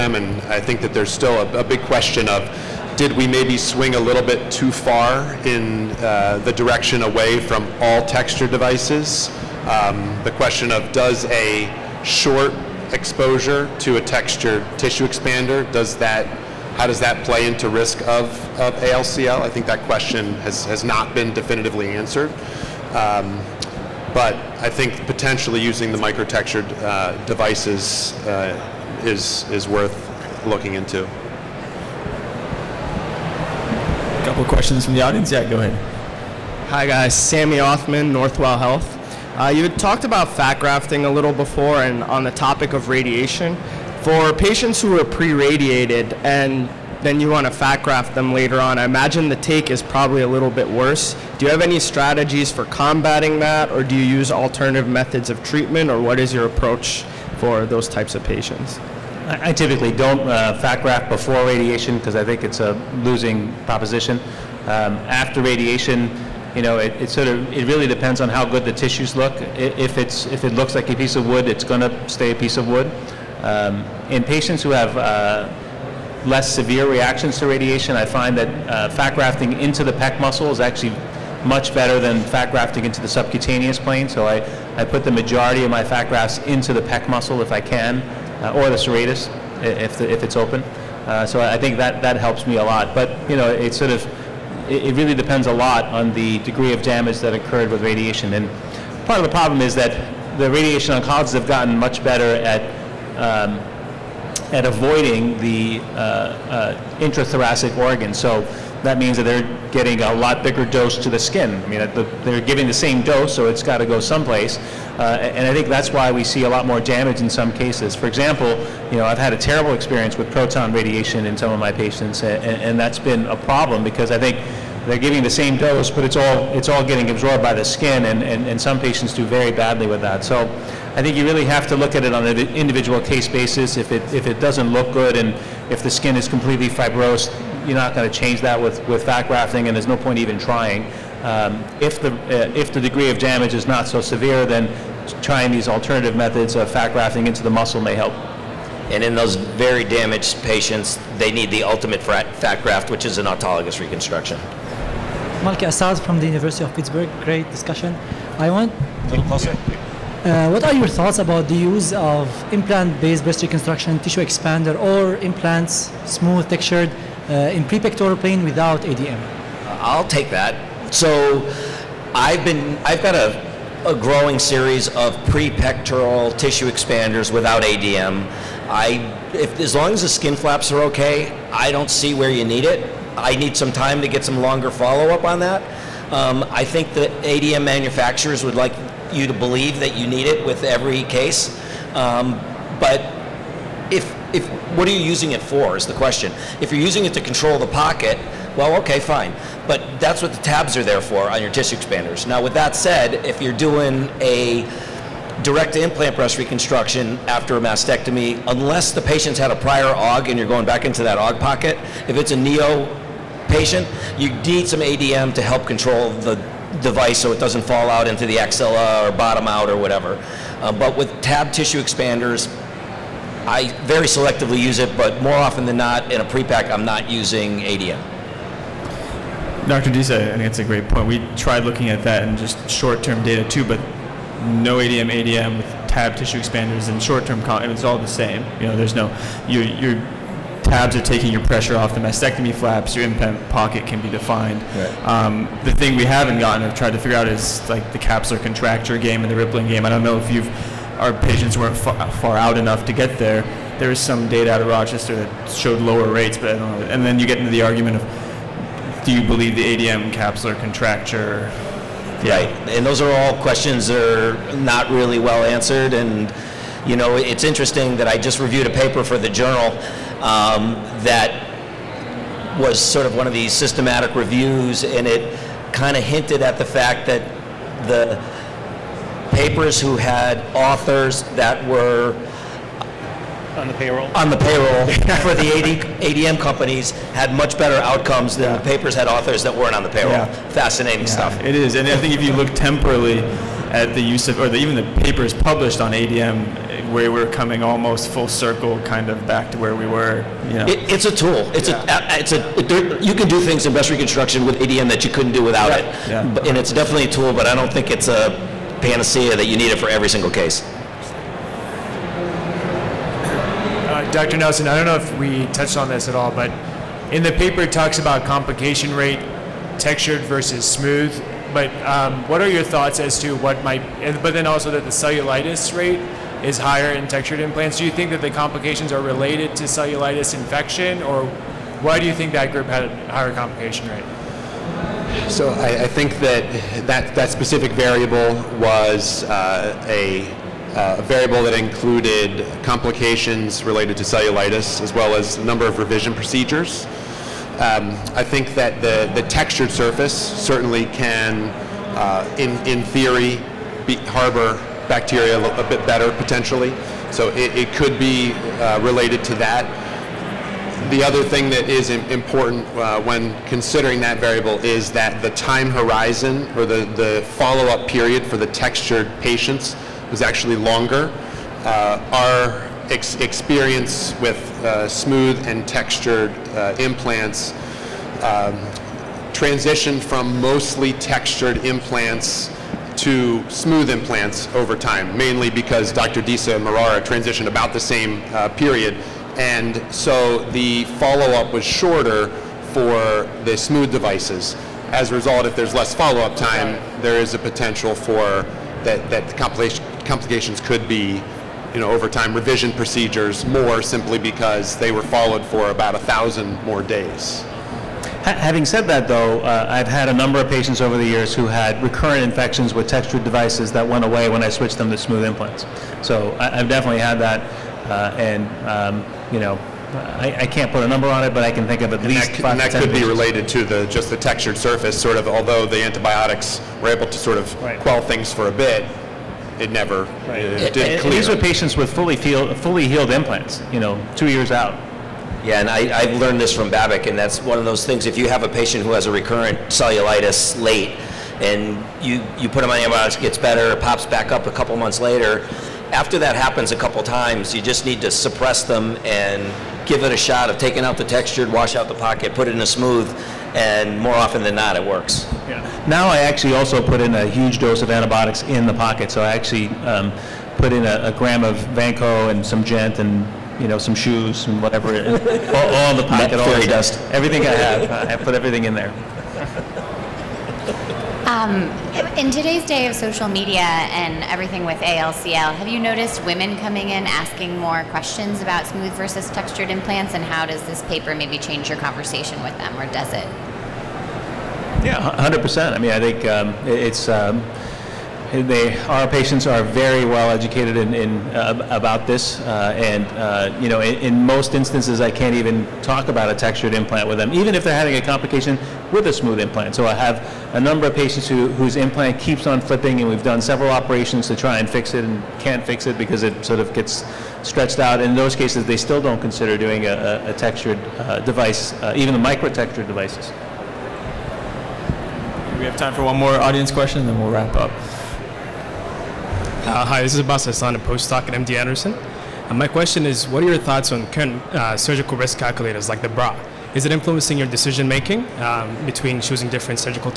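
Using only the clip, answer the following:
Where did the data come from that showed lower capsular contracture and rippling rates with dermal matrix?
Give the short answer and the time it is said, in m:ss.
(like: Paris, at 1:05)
Rochester, at 4:14.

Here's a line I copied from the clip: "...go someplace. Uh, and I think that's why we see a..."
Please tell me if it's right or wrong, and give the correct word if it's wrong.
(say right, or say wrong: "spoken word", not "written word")
right.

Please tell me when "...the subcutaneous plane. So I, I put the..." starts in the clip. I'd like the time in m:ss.
1:23.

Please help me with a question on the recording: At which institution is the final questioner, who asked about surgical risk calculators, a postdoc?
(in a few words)
MD Anderson.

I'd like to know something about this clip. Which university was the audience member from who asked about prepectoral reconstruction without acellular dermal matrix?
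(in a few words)
University of Pittsburgh.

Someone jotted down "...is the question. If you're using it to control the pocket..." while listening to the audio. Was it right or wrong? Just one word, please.
right.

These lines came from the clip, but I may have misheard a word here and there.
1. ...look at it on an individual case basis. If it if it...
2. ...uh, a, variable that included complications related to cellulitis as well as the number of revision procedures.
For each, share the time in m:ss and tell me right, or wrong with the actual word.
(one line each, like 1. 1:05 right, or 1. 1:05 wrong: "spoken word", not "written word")
1. 2:11 right
2. 5:40 right.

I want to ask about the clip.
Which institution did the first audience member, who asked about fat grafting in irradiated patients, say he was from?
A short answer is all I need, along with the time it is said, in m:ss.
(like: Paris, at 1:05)
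Northwell Health, at 0:38.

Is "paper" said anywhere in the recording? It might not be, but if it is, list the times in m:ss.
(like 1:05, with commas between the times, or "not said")
4:28, 4:39, 4:48, 4:55, 5:17, 8:00.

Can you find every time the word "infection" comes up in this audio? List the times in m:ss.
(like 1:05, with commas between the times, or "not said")
5:30, 6:52.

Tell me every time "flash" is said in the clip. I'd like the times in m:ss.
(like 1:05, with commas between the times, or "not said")
not said.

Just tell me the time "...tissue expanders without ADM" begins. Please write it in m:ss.
2:56.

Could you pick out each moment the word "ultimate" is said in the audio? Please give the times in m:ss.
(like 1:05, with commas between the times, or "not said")
2:31.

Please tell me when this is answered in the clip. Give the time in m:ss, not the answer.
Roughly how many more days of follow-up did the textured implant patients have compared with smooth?
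6:45.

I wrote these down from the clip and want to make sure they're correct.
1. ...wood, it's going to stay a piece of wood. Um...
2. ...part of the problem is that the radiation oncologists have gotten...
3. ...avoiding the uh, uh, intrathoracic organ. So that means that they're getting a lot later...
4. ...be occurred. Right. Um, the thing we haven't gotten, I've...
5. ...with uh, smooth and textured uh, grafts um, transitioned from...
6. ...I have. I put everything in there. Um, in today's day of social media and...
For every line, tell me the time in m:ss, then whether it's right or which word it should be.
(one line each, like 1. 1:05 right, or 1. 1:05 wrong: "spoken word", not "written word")
1. 1:11 right
2. 1:39 right
3. 1:44 wrong: "bigger", not "later"
4. 4:04 wrong: "defined", not "occurred"
5. 6:14 wrong: "implants", not "grafts"
6. 7:47 right.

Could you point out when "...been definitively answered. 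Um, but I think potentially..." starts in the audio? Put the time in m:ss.
0:21.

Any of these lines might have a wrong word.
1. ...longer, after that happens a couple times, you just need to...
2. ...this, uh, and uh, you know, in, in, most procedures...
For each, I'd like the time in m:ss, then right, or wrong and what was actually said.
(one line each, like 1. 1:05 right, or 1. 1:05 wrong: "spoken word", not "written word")
1. 7:25 wrong: "later", not "longer"
2. 8:12 wrong: "instances", not "procedures".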